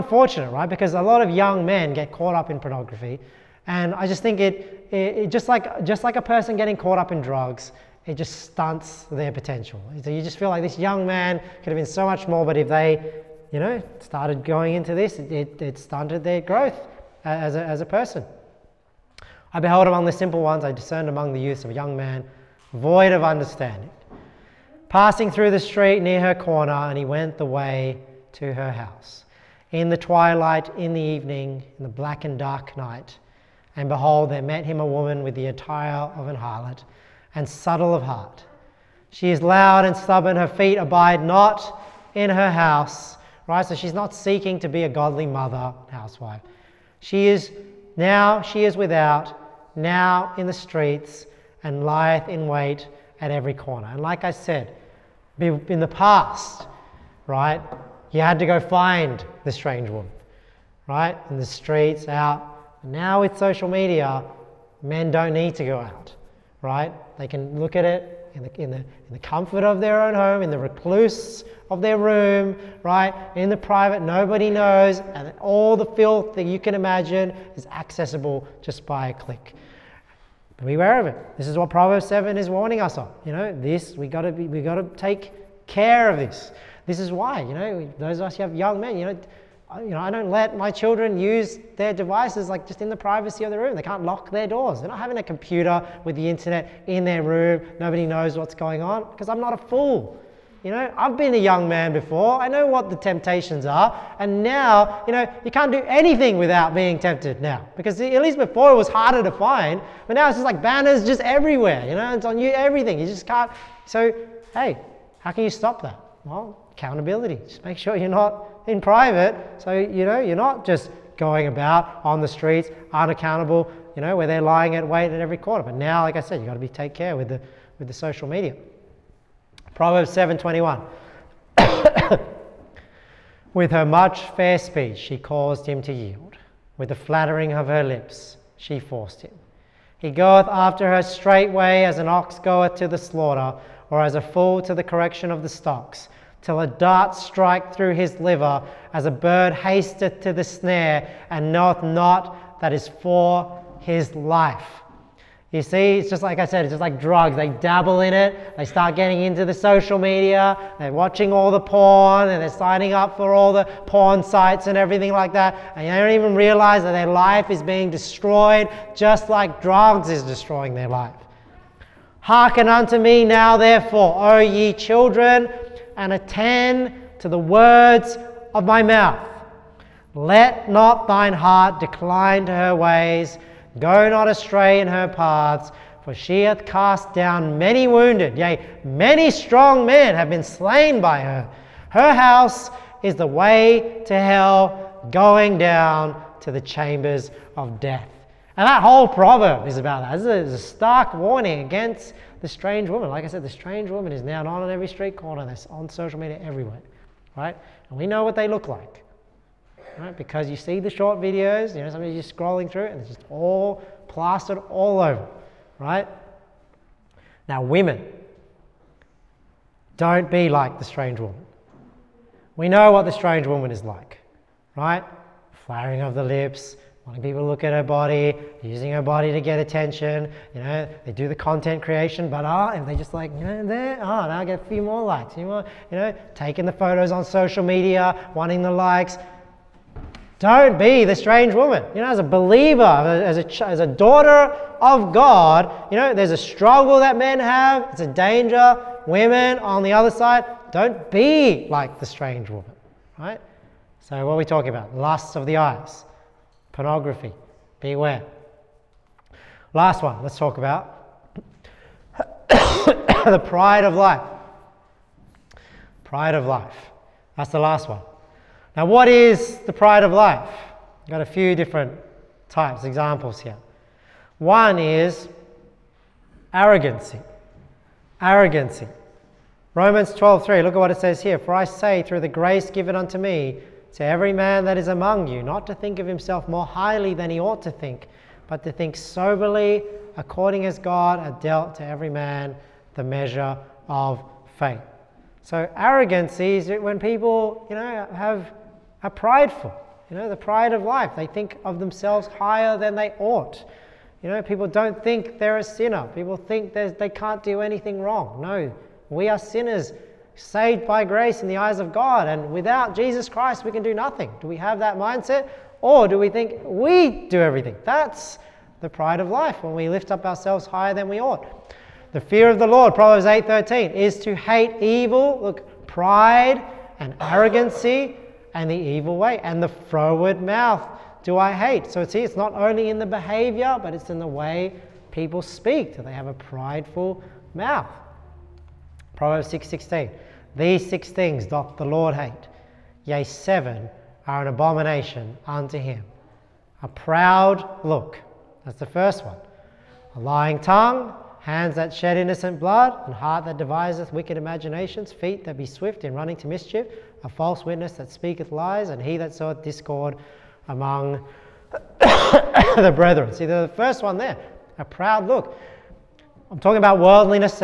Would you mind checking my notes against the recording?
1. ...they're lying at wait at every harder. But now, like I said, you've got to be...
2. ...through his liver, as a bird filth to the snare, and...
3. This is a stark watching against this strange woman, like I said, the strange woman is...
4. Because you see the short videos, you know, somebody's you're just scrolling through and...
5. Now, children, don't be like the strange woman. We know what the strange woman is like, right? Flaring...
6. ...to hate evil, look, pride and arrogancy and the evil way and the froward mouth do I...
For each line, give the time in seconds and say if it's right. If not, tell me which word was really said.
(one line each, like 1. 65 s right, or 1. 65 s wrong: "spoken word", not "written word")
1. 124 s wrong: "corner", not "harder"
2. 147 s wrong: "hasteth", not "filth"
3. 200 s wrong: "warning", not "watching"
4. 210 s right
5. 217 s wrong: "women", not "children"
6. 324 s right.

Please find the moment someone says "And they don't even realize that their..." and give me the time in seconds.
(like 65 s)
165 s.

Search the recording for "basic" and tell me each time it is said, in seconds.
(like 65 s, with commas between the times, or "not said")
not said.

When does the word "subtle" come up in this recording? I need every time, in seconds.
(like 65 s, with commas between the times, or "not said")
37 s.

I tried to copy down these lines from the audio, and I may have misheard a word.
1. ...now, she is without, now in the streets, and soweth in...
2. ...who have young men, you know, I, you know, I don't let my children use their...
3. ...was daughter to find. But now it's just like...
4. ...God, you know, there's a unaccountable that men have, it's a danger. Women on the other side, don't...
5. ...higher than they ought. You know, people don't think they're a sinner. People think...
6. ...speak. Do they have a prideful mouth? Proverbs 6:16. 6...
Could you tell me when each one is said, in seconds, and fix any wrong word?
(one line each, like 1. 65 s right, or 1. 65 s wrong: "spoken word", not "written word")
1. 47 s wrong: "lieth", not "soweth"
2. 88 s right
3. 108 s wrong: "harder", not "daughter"
4. 245 s wrong: "struggle", not "unaccountable"
5. 302 s right
6. 335 s right.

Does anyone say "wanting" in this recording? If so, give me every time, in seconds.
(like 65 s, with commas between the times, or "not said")
227 s, 238 s.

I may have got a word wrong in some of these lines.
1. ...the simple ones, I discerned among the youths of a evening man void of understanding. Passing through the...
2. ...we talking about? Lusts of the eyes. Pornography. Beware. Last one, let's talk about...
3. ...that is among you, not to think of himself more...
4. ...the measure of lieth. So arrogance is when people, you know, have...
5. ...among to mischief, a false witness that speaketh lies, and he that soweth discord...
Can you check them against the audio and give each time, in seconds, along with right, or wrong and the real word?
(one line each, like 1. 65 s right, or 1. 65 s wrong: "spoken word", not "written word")
1. 20 s wrong: "young", not "evening"
2. 254 s right
3. 284 s right
4. 292 s wrong: "faith", not "lieth"
5. 356 s wrong: "running", not "among".